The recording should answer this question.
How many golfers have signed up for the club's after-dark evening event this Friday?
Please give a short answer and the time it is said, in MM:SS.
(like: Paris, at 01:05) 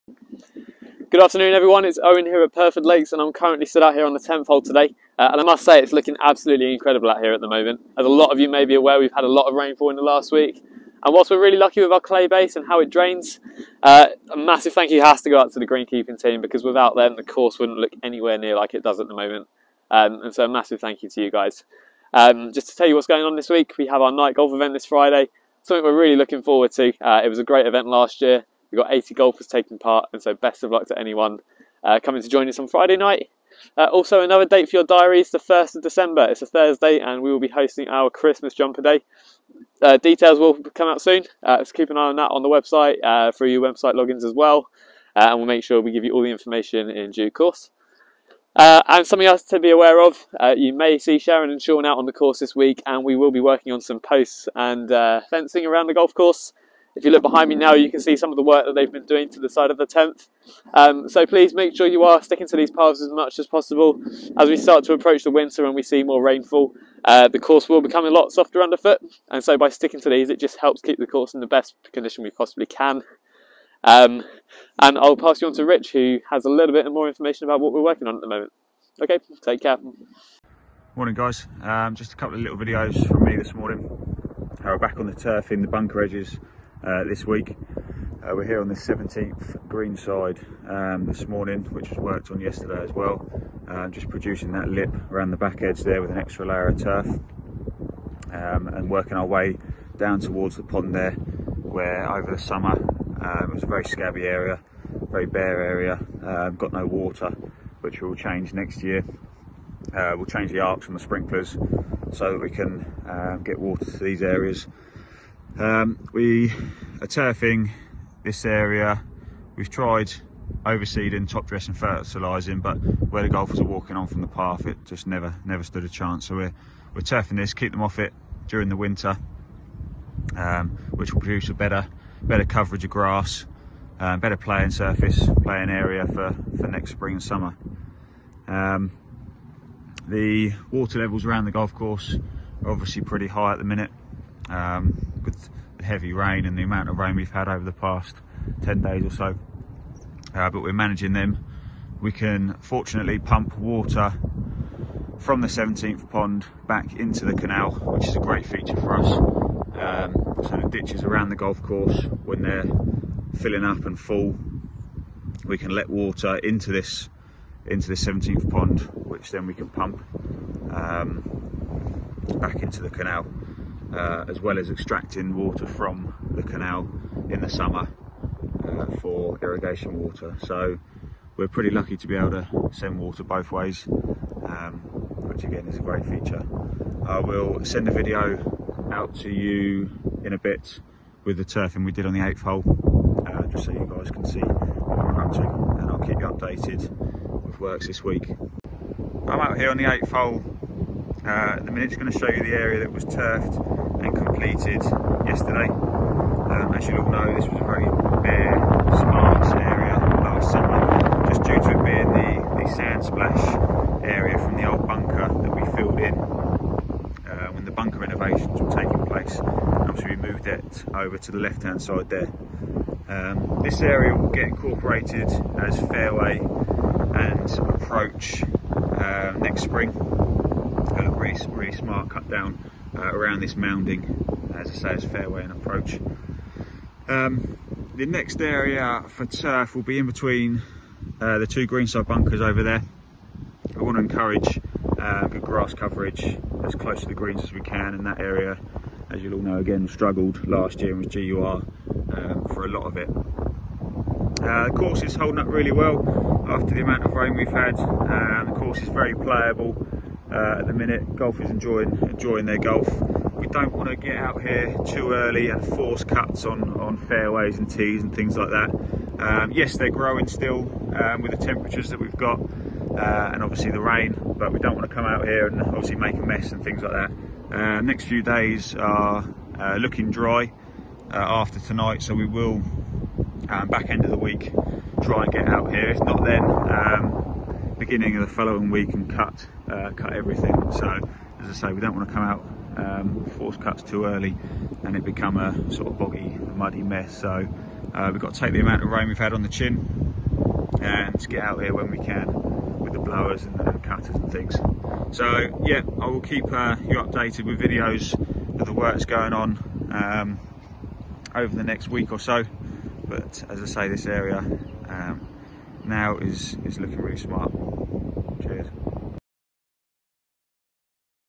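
80, at 00:28.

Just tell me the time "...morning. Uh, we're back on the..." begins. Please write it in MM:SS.
01:23.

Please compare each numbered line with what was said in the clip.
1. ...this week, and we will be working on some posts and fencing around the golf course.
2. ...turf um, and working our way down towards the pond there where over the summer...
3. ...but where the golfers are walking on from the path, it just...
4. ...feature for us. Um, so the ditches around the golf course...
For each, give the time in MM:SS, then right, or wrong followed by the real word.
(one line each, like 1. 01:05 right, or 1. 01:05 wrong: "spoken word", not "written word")
1. 00:52 right
2. 01:36 right
3. 02:02 right
4. 02:38 right.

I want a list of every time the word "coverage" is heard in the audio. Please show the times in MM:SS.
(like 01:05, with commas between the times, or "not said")
02:12, 04:05.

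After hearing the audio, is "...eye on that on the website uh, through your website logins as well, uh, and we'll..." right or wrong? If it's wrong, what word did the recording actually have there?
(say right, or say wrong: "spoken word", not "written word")
right.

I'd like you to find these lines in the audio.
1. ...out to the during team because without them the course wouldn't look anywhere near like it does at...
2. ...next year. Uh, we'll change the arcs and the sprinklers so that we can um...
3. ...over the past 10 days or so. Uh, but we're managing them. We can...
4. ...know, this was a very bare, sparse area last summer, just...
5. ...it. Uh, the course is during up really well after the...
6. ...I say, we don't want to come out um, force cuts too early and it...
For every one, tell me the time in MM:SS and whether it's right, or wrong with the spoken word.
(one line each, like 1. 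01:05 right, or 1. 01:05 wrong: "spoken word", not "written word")
1. 00:15 wrong: "greenkeeping", not "during"
2. 01:48 right
3. 02:27 right
4. 03:27 right
5. 04:12 wrong: "holding", not "during"
6. 04:51 right.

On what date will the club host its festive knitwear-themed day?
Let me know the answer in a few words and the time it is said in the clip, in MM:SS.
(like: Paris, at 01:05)
1st of December, at 00:35.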